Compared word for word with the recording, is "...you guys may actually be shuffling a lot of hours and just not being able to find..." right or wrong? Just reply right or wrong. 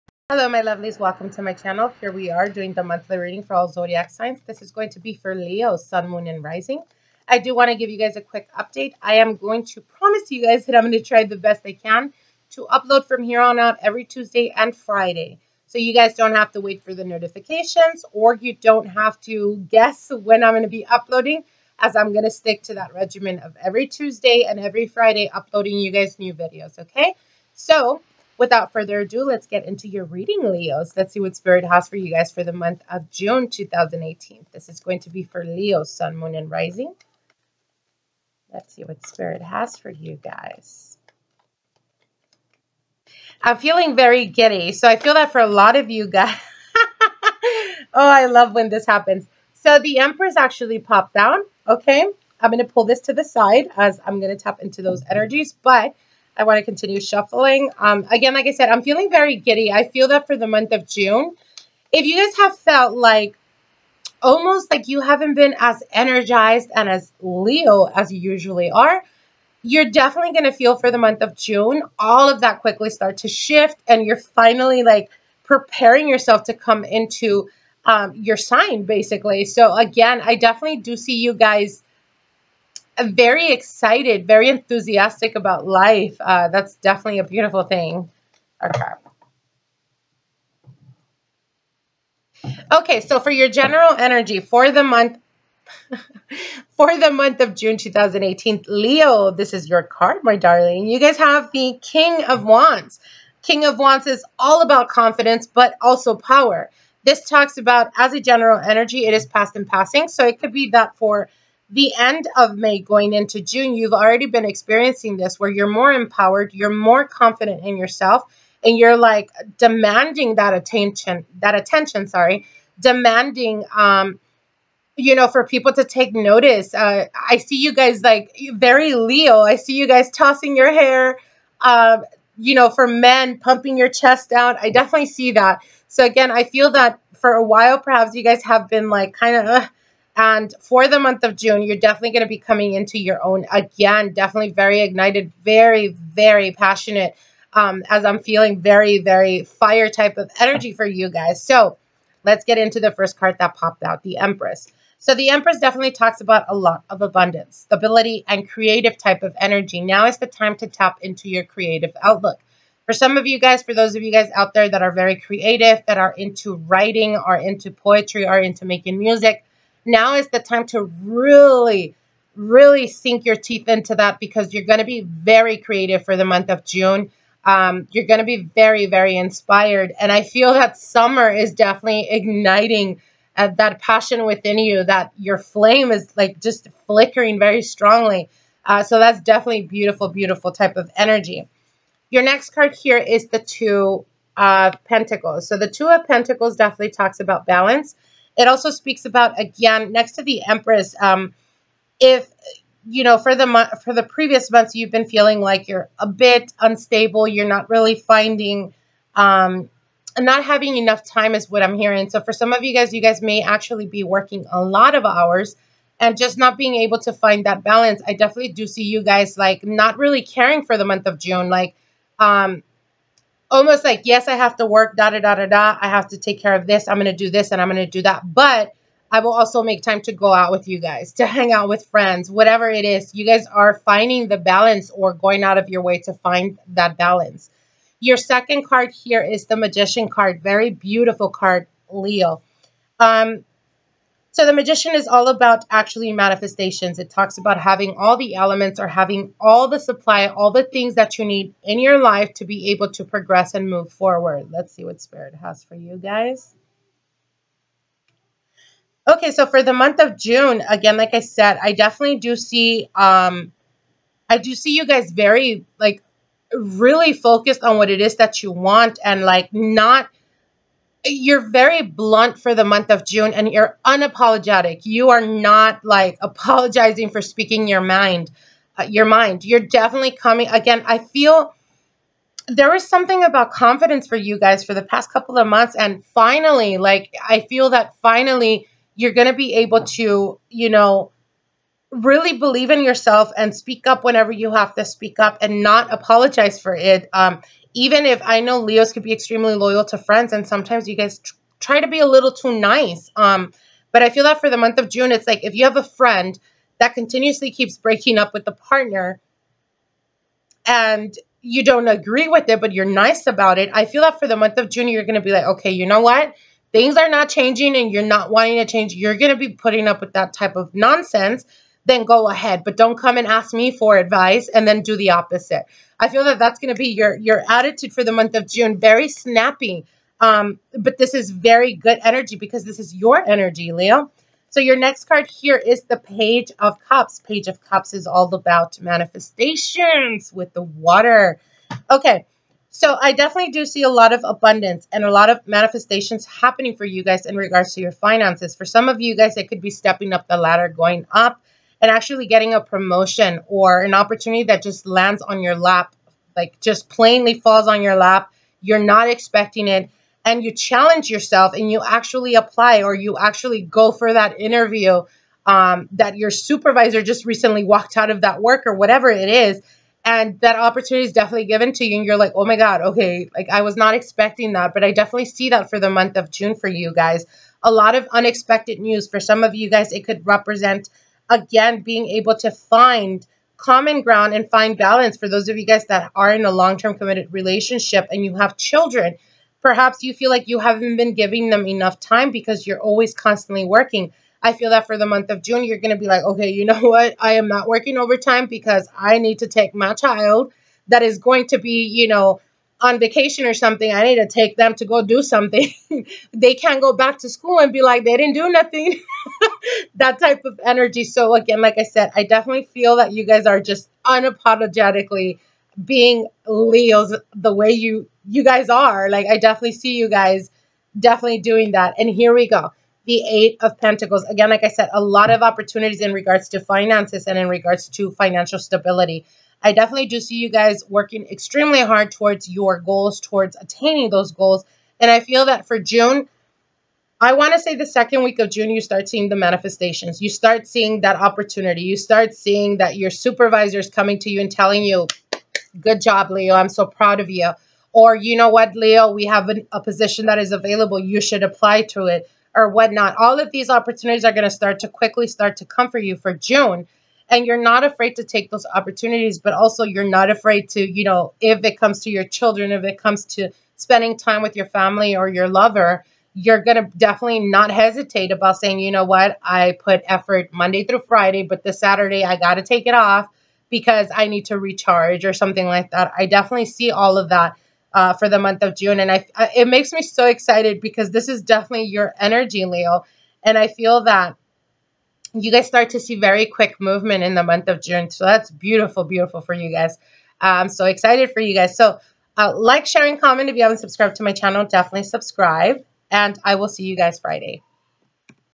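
wrong.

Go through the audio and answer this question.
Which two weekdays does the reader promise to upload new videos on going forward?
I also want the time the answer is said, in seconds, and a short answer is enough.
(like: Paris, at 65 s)
Tuesday and Friday, at 14 s.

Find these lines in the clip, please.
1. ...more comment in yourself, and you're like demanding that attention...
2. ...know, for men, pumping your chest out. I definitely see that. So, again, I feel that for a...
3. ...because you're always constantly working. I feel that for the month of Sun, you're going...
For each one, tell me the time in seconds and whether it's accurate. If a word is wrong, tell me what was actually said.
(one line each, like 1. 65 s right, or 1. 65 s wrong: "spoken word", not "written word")
1. 116 s wrong: "confident", not "comment"
2. 132 s right
3. 392 s wrong: "June", not "Sun".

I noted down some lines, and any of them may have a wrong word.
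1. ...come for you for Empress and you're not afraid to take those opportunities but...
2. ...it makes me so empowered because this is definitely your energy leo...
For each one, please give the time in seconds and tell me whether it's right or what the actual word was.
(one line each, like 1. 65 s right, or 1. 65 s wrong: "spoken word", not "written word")
1. 455 s wrong: "June", not "Empress"
2. 479 s wrong: "excited", not "empowered".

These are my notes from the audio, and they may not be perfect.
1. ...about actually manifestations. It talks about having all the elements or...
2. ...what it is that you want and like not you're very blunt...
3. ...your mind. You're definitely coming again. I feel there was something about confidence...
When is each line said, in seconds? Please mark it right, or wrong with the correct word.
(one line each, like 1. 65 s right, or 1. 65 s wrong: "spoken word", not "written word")
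1. 245 s right
2. 267 s right
3. 278 s right.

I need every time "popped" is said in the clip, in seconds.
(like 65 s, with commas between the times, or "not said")
50 s, 153 s.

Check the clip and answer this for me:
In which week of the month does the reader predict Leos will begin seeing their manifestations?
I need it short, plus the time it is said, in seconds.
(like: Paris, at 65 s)
second week, at 437 s.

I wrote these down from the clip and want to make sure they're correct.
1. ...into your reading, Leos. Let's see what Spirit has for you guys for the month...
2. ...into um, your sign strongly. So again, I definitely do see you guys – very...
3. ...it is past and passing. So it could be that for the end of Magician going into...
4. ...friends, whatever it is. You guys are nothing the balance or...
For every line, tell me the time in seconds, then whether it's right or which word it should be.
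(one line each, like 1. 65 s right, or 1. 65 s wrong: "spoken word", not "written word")
1. 29 s right
2. 76 s wrong: "basically", not "strongly"
3. 109 s wrong: "May", not "Magician"
4. 231 s wrong: "finding", not "nothing".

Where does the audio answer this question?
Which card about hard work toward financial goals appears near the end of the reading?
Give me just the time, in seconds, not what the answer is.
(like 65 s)
423 s.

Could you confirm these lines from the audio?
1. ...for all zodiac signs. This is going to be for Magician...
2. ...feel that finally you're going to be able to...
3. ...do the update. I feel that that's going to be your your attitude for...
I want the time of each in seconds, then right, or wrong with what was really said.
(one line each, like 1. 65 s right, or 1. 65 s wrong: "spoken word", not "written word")
1. 3 s wrong: "Leo", not "Magician"
2. 287 s right
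3. 324 s wrong: "opposite", not "update".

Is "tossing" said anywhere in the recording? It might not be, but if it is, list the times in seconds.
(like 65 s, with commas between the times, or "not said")
130 s.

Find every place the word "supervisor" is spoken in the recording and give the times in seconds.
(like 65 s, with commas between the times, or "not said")
366 s, 443 s.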